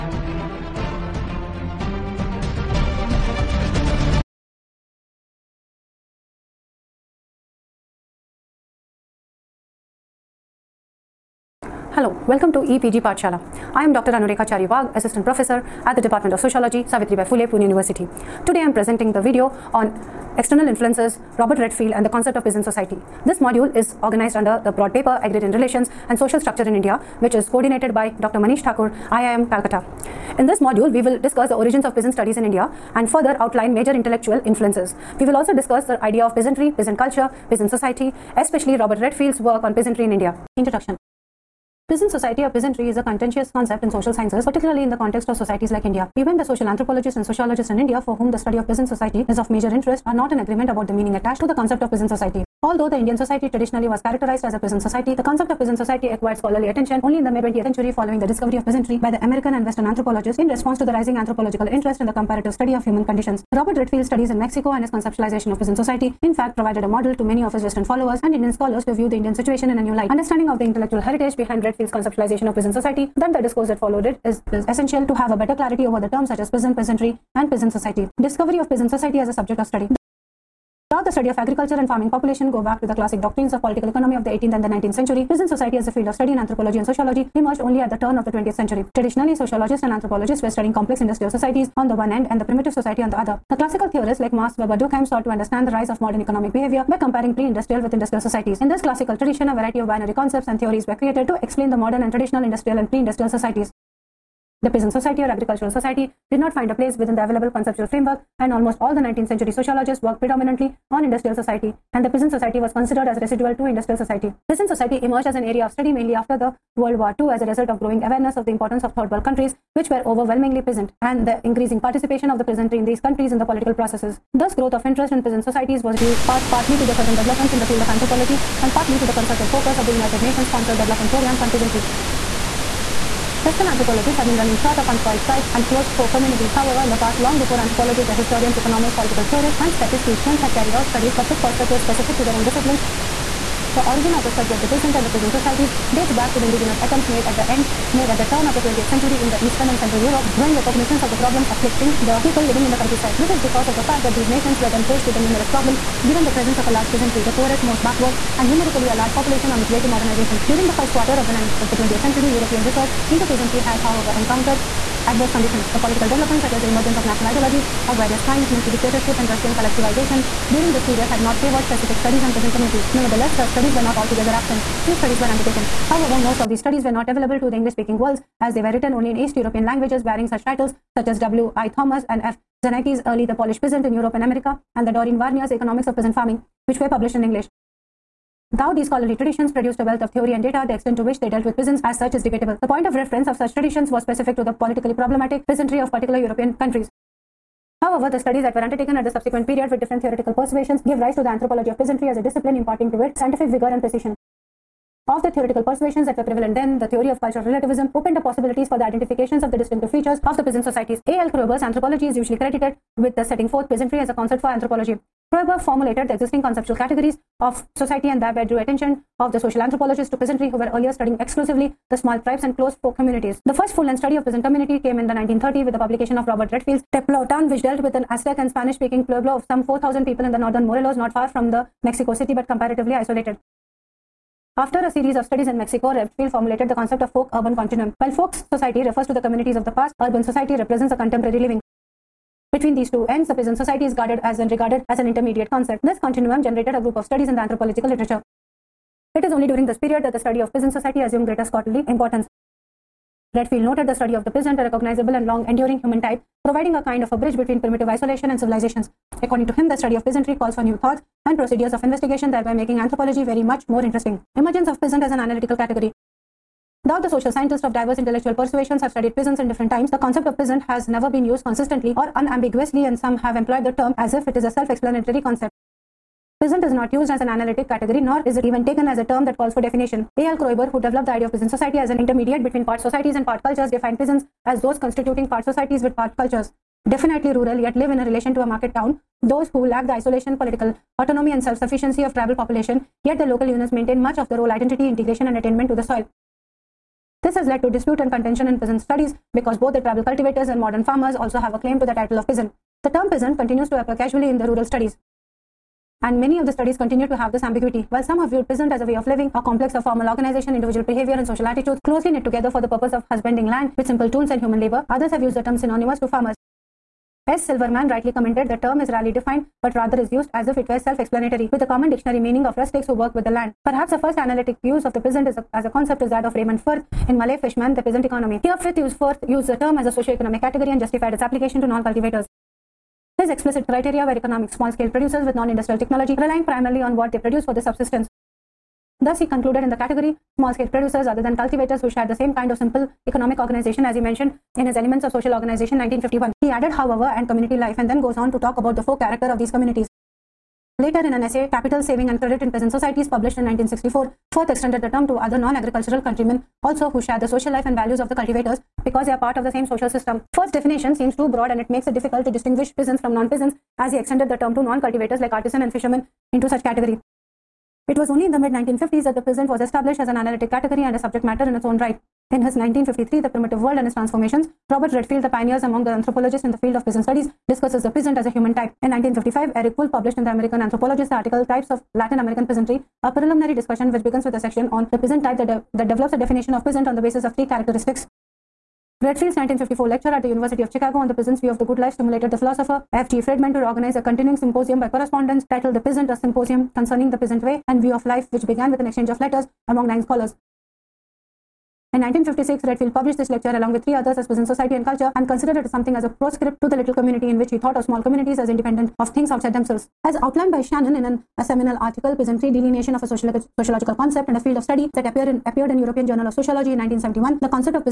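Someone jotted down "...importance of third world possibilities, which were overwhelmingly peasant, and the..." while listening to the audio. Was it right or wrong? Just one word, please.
wrong.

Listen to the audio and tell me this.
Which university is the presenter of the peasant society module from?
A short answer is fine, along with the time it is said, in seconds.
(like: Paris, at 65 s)
Savitribai Phule Pune University, at 16 s.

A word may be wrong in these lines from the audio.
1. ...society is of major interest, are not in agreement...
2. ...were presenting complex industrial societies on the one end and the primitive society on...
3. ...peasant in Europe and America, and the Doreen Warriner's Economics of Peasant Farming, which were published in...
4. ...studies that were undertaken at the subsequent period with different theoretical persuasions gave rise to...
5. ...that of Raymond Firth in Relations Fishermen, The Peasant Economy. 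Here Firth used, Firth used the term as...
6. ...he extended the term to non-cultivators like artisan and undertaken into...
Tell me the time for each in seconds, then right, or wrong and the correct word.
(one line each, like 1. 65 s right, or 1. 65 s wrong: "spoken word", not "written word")
1. 48 s right
2. 90 s wrong: "studying", not "presenting"
3. 183 s right
4. 198 s right
5. 326 s wrong: "Malay", not "Relations"
6. 363 s wrong: "fishermen", not "undertaken".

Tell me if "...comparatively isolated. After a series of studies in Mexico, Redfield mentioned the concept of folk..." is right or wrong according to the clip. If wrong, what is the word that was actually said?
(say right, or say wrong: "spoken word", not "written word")
wrong: "formulated", not "mentioned".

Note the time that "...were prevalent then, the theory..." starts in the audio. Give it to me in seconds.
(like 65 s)
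206 s.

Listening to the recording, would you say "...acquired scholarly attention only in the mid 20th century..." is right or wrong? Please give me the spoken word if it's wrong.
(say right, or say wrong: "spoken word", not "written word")
right.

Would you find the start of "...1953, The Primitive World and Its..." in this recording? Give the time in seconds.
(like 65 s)
372 s.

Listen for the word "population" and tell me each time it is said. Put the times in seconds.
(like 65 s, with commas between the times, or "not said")
82 s, 159 s, 292 s.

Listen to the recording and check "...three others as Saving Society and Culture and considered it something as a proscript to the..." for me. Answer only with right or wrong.
wrong.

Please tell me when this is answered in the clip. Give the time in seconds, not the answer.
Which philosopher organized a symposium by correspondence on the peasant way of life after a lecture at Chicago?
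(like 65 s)
392 s.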